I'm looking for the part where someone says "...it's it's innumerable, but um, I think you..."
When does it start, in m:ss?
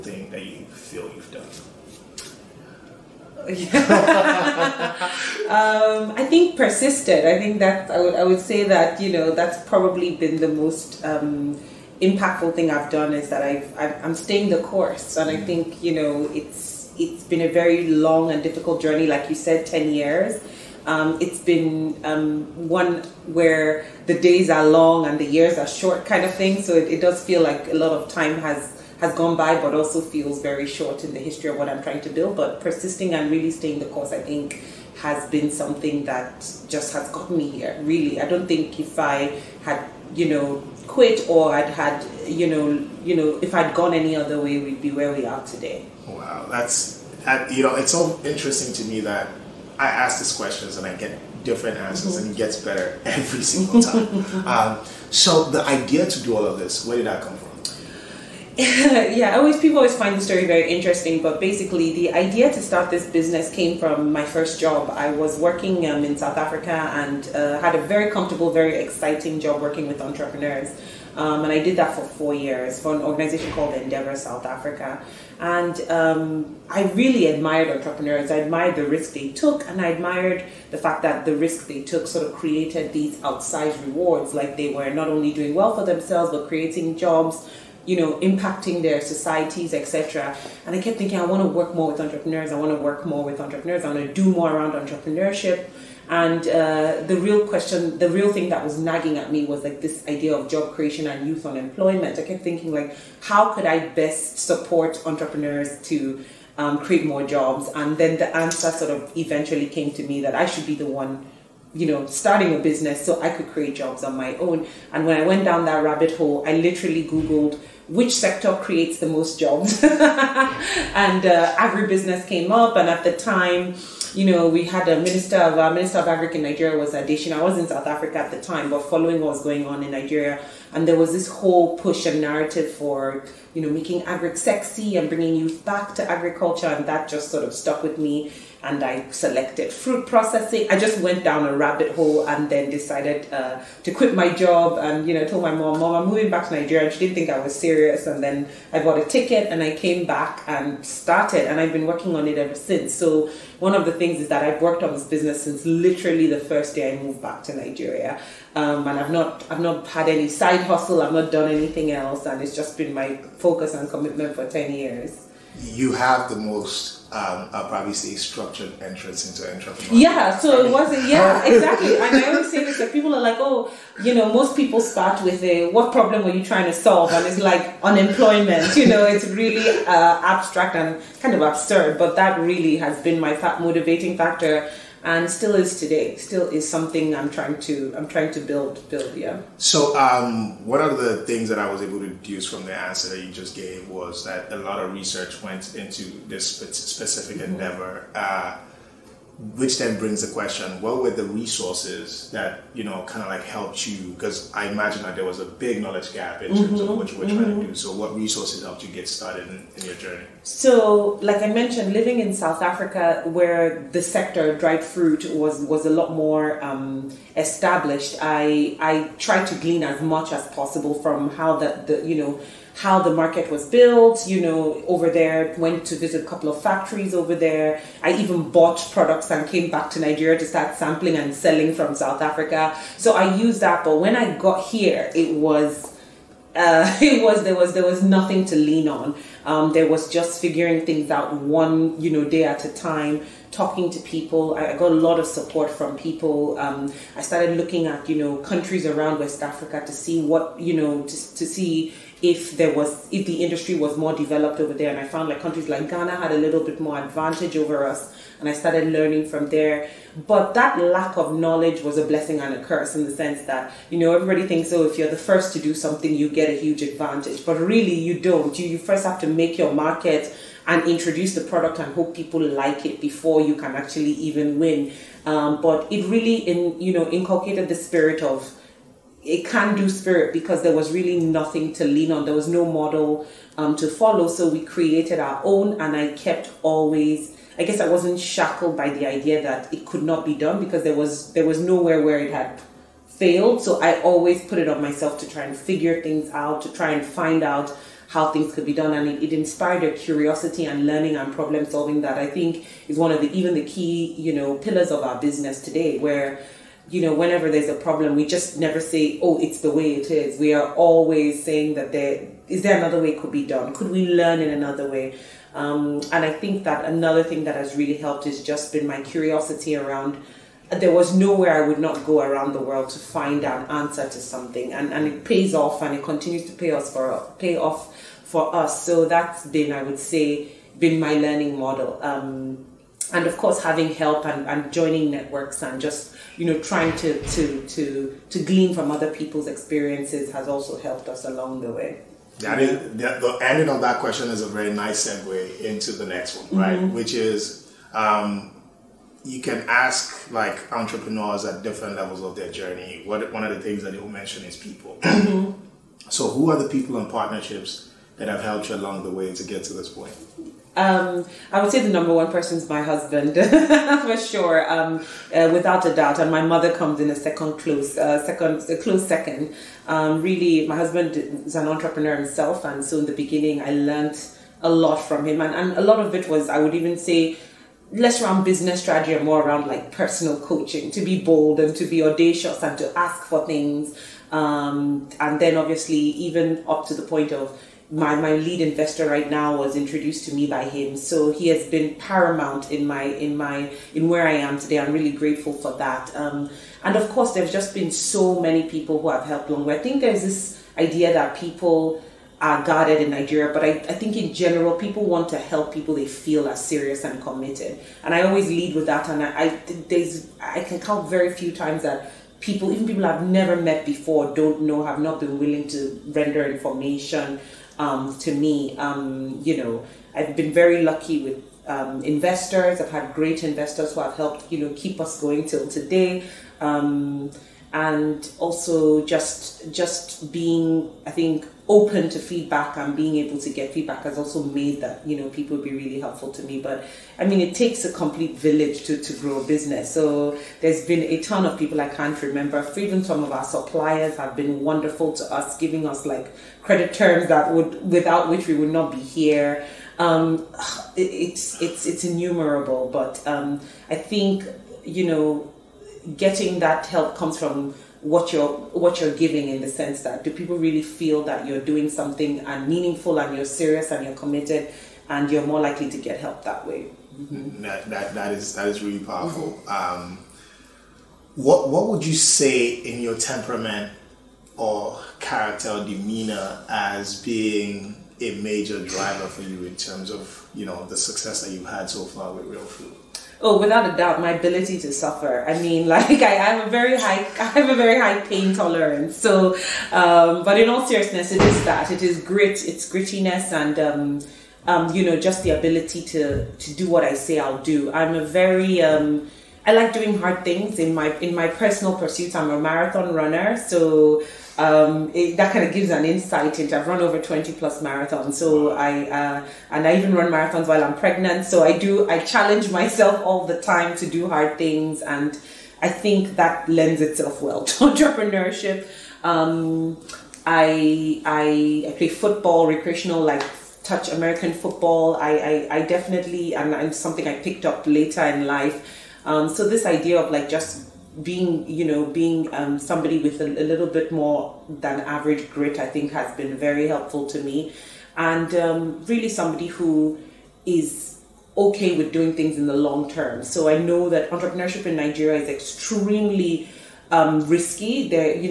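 7:31.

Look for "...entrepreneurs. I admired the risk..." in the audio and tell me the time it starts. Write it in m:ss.
1:17.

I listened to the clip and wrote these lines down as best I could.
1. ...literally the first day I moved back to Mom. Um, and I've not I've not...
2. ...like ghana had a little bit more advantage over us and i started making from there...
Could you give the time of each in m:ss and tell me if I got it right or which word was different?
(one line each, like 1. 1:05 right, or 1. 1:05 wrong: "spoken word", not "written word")
1. 2:35 wrong: "Nigeria", not "Mom"
2. 4:15 wrong: "learning", not "making".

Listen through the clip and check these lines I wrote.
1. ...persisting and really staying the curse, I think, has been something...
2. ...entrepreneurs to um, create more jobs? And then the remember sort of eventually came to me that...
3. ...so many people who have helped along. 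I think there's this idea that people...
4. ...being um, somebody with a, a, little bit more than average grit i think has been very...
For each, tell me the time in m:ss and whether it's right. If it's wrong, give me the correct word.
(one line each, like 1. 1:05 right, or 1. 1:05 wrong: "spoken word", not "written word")
1. 0:32 wrong: "course", not "curse"
2. 1:45 wrong: "answer", not "remember"
3. 6:37 right
4. 8:52 right.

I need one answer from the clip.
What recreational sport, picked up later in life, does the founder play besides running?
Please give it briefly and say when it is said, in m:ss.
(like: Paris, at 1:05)
Touch American football, at 8:43.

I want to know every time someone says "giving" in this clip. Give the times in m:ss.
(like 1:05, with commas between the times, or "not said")
7:25, 7:39.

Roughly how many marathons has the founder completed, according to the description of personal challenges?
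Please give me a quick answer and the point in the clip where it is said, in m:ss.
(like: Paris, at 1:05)
20+, at 8:27.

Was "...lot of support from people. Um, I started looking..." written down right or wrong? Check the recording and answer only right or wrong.
right.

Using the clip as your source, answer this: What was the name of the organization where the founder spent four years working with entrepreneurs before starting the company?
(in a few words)
Endeavor South Africa.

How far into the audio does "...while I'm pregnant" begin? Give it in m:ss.
8:30.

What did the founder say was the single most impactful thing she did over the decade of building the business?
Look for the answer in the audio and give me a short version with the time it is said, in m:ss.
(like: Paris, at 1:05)
Persisted, at 0:06.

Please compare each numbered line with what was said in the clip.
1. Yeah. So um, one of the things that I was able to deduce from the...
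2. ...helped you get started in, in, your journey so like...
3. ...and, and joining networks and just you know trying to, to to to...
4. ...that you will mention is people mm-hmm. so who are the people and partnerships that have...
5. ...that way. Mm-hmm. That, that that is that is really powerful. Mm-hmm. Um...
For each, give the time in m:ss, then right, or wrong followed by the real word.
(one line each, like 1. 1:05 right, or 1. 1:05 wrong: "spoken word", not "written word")
1. 3:09 right
2. 3:28 right
3. 5:34 right
4. 5:53 right
5. 7:46 right.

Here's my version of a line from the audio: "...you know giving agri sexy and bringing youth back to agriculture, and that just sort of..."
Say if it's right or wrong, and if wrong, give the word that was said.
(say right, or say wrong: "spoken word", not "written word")
wrong: "making", not "giving".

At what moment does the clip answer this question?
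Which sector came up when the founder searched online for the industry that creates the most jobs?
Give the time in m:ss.
2:01.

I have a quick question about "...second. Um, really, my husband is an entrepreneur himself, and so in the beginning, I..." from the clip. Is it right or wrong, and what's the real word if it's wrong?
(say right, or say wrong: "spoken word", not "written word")
right.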